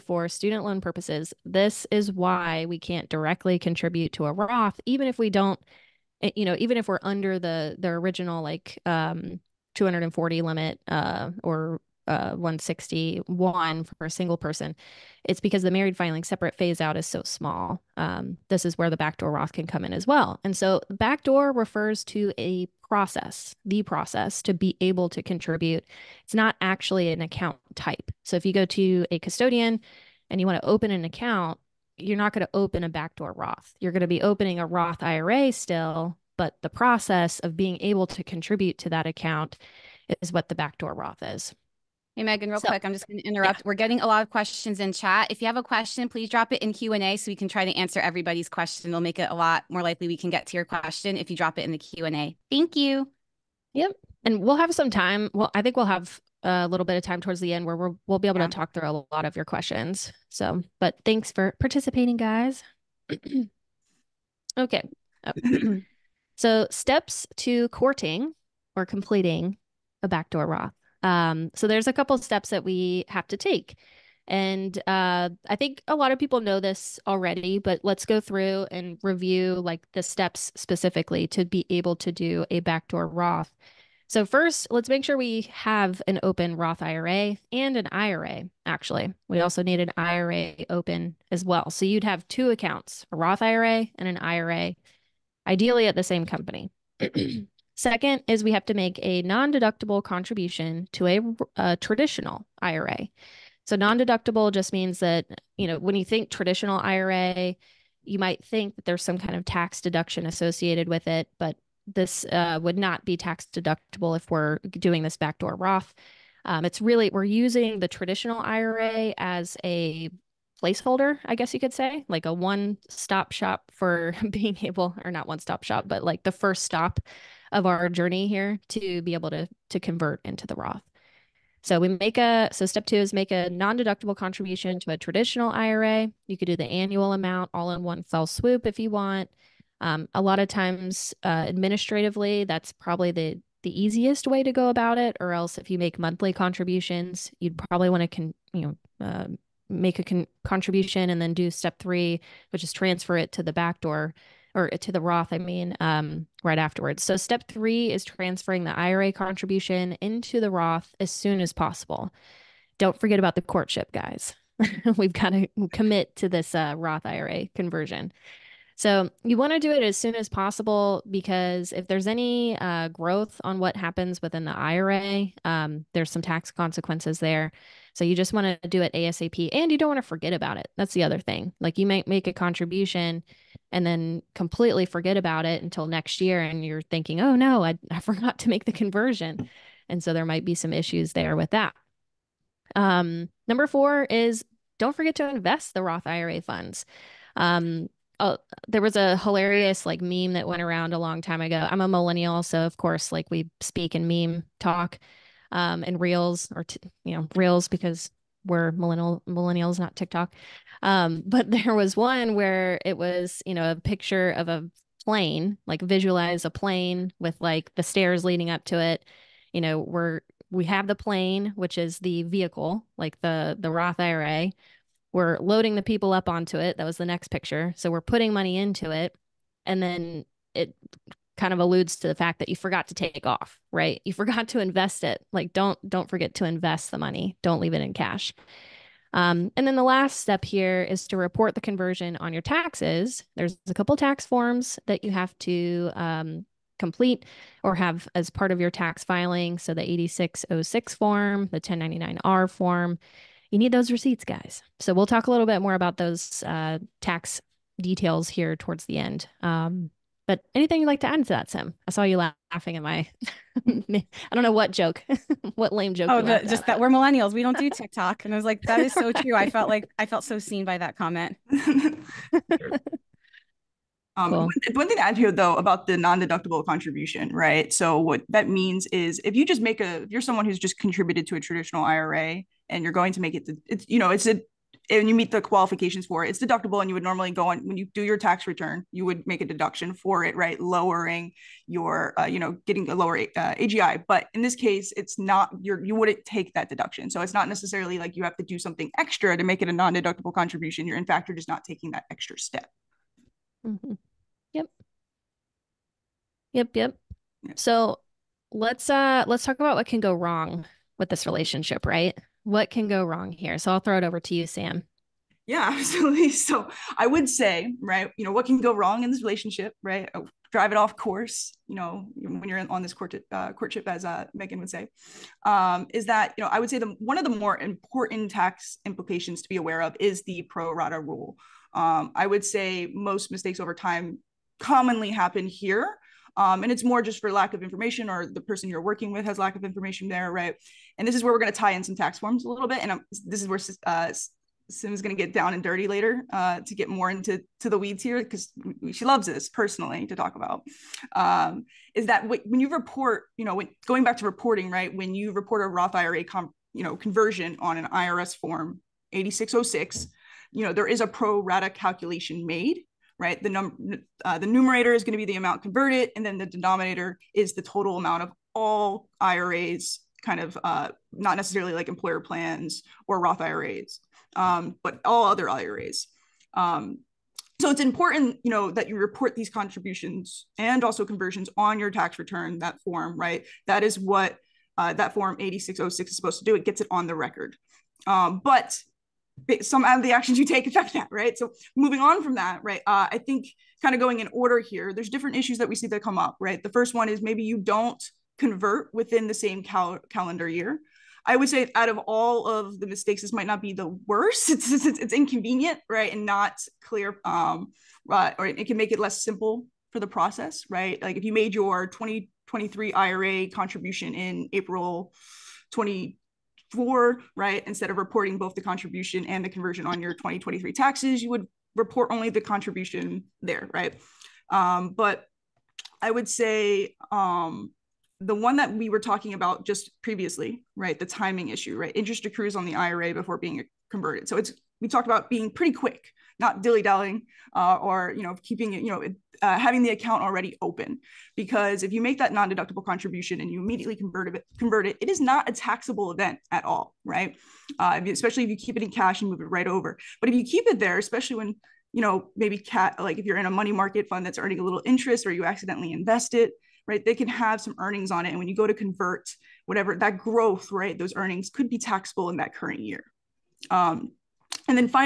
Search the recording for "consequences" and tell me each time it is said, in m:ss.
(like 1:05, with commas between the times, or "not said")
2:56.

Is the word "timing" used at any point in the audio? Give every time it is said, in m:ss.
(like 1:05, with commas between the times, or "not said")
7:11.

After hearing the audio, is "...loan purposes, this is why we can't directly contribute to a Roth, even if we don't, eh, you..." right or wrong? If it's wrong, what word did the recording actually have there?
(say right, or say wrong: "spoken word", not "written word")
right.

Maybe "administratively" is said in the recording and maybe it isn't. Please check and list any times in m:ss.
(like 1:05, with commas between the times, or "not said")
2:21.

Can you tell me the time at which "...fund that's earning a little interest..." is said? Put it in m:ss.
7:34.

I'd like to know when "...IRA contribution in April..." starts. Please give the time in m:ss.
6:52.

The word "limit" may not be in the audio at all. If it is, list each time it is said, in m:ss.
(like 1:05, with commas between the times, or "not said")
0:10.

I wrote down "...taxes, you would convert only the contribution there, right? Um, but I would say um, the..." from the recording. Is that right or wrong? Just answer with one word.
wrong.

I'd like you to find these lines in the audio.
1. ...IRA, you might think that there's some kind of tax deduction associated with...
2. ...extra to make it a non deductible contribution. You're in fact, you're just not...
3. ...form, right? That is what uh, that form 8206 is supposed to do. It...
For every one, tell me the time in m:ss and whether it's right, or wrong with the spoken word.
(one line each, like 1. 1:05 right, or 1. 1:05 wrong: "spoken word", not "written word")
1. 1:46 right
2. 4:58 right
3. 6:22 wrong: "8606", not "8206".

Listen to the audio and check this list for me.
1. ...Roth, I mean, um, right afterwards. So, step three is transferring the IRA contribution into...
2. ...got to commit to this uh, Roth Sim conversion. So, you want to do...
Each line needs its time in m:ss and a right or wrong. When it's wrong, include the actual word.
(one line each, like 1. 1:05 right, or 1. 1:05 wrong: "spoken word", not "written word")
1. 2:35 right
2. 2:45 wrong: "IRA", not "Sim".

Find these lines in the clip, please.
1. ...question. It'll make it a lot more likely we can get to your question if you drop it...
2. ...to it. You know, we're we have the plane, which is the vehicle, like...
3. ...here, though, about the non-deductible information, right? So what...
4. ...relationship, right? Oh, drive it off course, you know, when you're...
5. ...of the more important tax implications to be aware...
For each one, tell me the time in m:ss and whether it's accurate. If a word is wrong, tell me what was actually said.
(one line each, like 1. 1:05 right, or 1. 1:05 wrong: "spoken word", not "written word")
1. 0:48 right
2. 3:38 right
3. 4:35 wrong: "contribution", not "information"
4. 5:19 right
5. 5:27 right.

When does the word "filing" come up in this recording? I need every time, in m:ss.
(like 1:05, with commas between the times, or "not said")
0:15, 4:09.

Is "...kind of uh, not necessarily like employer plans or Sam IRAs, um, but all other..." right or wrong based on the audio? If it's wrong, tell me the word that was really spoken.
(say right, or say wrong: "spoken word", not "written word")
wrong: "Roth", not "Sam".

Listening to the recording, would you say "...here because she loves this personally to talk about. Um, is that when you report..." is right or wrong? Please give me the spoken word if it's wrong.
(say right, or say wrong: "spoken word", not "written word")
right.